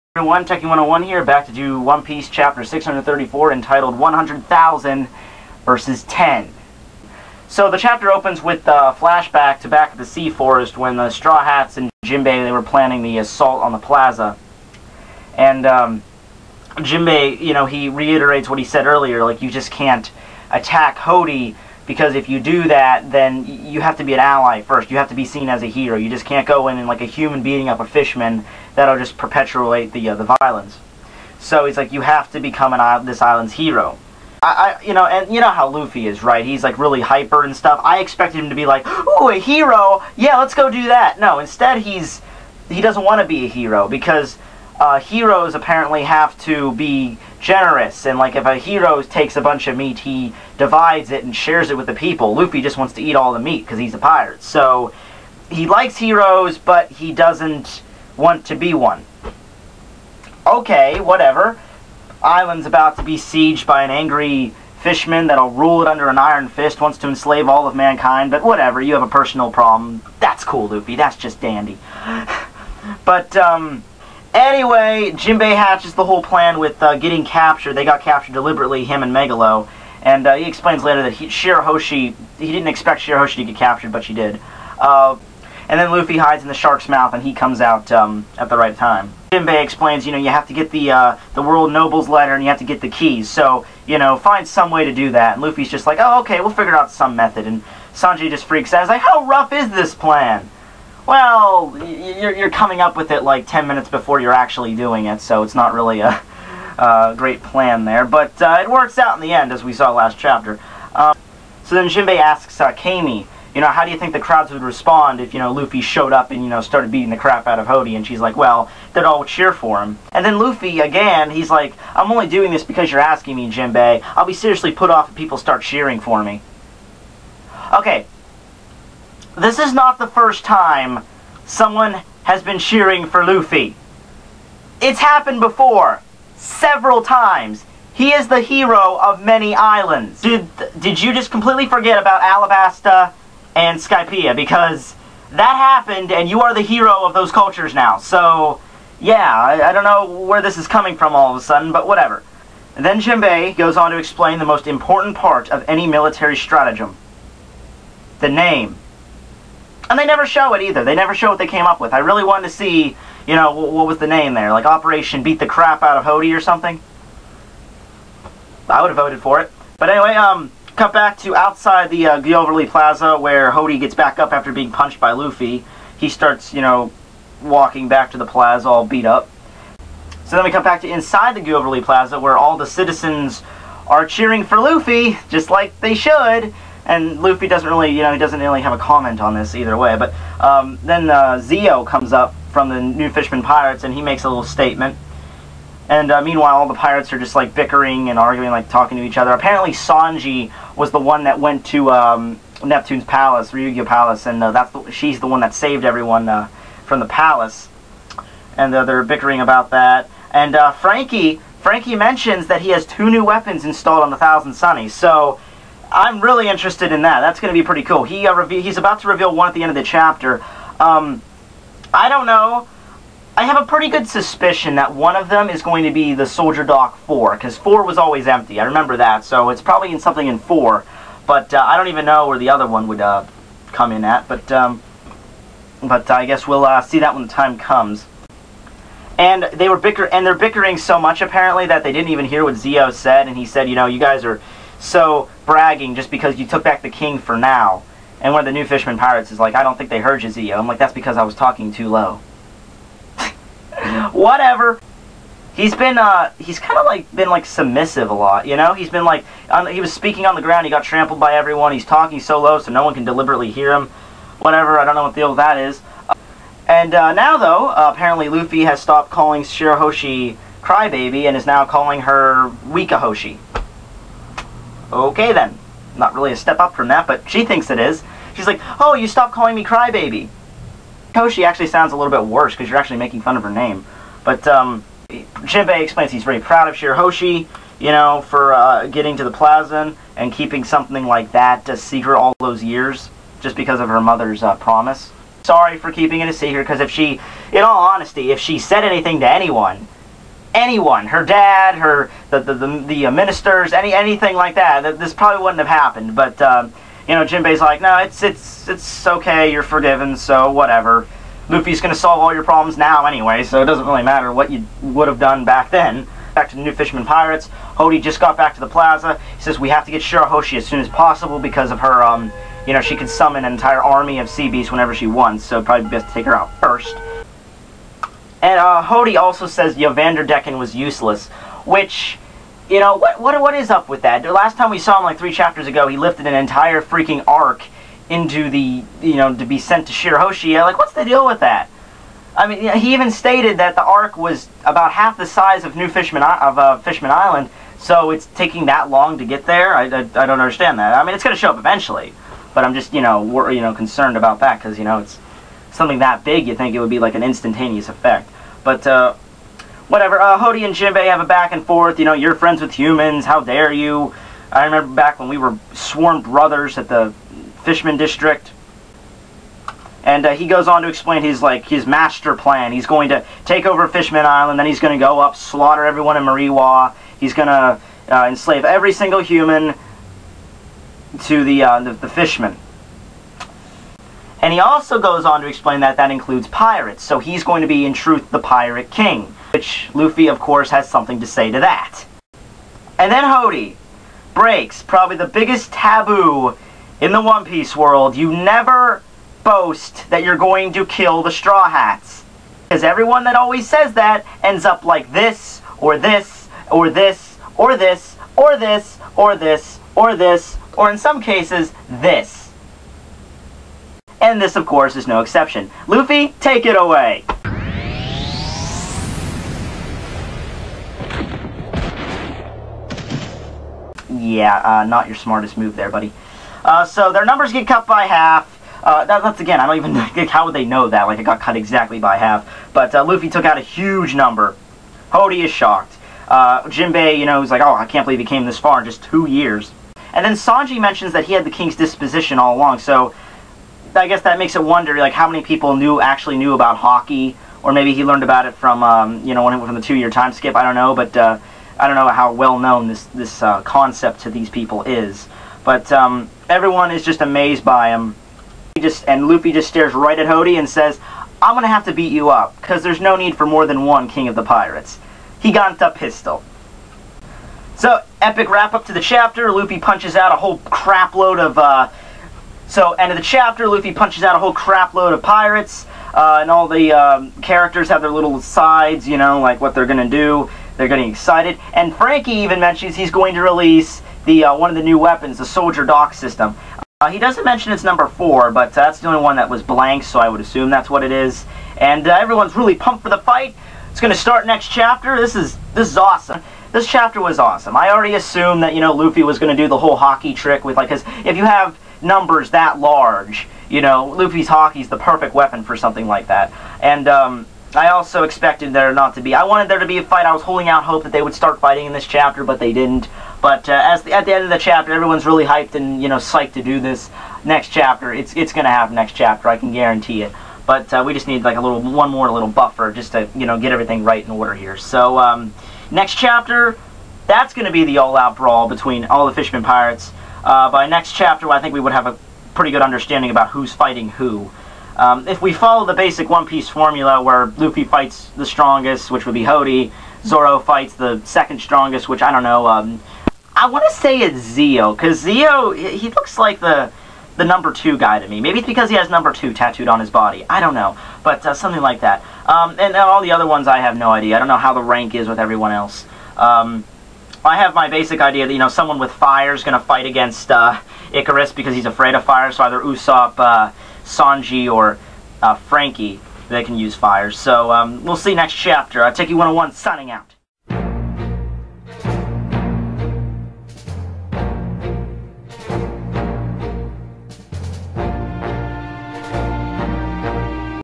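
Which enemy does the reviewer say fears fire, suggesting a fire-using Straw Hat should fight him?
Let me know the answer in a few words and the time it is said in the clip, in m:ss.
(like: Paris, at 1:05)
Ikaros, at 9:21.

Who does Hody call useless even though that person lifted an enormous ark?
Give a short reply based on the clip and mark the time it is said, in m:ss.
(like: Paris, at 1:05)
Vanderdecken, at 5:29.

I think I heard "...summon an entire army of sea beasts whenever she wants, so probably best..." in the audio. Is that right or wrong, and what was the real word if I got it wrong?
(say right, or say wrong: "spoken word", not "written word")
right.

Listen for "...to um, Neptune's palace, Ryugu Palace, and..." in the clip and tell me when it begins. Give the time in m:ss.
3:21.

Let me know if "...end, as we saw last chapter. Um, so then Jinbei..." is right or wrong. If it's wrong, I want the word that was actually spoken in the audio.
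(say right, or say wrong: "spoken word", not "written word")
right.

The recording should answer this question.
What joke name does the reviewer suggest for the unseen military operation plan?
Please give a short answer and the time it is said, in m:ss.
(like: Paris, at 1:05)
Operation Beat the Crap Out of Hody, at 2:44.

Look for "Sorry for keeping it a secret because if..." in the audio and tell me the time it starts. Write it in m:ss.
4:55.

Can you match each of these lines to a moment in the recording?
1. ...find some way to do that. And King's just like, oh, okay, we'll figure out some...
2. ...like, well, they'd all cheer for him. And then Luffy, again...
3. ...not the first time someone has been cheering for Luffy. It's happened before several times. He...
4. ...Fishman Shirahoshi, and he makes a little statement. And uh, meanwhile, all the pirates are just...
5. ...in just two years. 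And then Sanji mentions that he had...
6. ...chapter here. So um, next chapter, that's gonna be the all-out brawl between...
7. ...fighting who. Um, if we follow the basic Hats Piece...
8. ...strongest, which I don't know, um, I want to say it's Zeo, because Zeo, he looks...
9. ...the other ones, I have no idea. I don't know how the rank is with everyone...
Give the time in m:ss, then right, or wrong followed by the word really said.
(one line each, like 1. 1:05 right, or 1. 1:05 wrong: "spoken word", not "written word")
1. 1:34 wrong: "Luffy", not "King"
2. 1:58 right
3. 2:09 right
4. 3:13 wrong: "Pirates", not "Shirahoshi"
5. 7:18 right
6. 8:44 wrong: "order", not "chapter"
7. 8:53 wrong: "One", not "Hats"
8. 9:01 right
9. 9:13 right.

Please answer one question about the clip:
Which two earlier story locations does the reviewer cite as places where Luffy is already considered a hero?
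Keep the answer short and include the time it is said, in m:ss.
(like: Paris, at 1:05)
Alabasta and Skypiea, at 2:22.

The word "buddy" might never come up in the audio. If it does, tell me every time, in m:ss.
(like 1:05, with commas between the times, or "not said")
7:05.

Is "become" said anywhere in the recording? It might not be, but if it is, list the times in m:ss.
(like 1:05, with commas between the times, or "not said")
0:32.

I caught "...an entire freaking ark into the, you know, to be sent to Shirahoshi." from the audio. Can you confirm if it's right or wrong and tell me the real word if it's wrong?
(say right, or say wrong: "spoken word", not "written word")
right.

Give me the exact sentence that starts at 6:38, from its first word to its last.
You never boast that you're going to kill the Straw Hats.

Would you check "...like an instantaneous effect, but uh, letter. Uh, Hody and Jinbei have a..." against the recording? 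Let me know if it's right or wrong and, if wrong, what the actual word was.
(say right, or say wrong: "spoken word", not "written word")
wrong: "whatever", not "letter".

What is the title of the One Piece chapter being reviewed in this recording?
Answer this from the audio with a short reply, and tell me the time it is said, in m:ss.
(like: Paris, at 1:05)
100,000 versus 10, at 0:03.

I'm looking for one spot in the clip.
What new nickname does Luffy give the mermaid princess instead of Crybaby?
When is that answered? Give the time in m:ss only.
4:32.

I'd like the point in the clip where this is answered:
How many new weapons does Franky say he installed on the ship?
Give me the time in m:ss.
3:32.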